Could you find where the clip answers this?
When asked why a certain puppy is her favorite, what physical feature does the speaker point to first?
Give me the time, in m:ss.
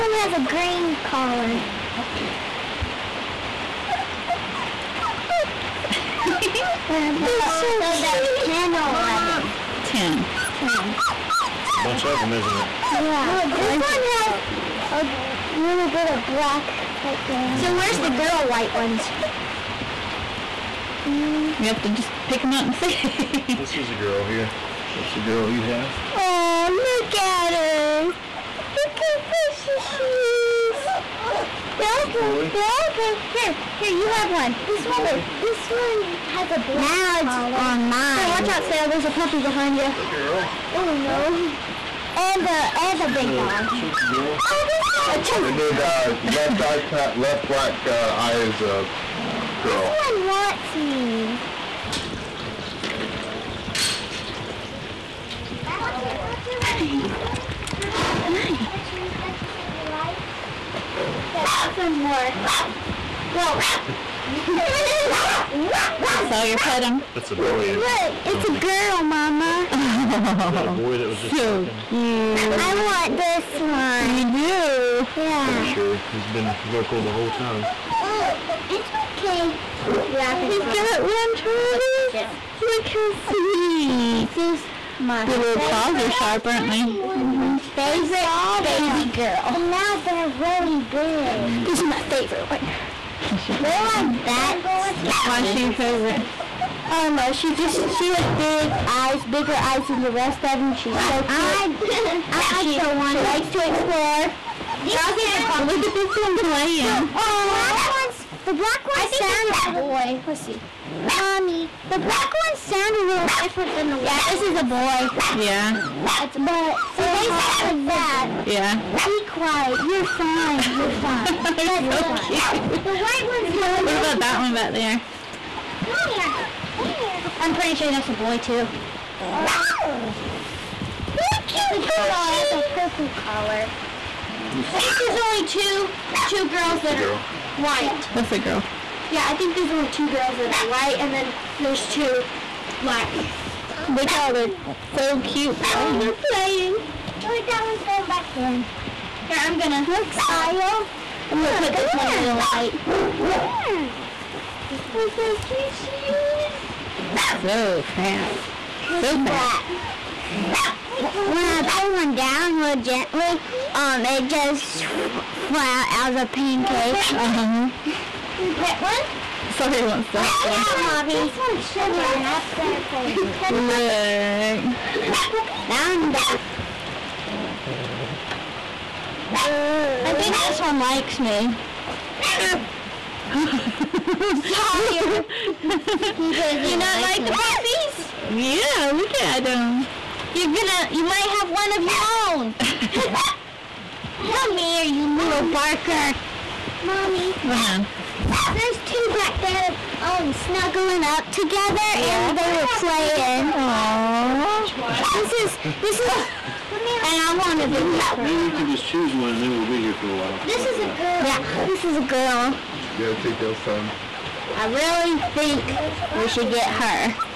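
1:38.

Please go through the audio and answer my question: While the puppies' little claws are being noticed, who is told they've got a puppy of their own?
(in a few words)
Travis.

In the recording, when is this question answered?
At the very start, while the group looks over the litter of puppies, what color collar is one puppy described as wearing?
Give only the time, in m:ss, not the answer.
0:00.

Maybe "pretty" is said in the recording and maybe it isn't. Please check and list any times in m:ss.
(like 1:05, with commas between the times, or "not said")
1:15, 2:07.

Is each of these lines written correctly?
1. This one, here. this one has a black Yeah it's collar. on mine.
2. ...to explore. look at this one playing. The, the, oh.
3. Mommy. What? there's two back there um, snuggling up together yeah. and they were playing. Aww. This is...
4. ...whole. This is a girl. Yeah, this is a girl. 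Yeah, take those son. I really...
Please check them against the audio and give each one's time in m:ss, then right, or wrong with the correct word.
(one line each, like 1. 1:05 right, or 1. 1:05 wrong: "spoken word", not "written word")
1. 0:34 wrong: "Now", not "Yeah"
2. 1:43 right
3. 3:16 right
4. 3:30 wrong: "while", not "whole".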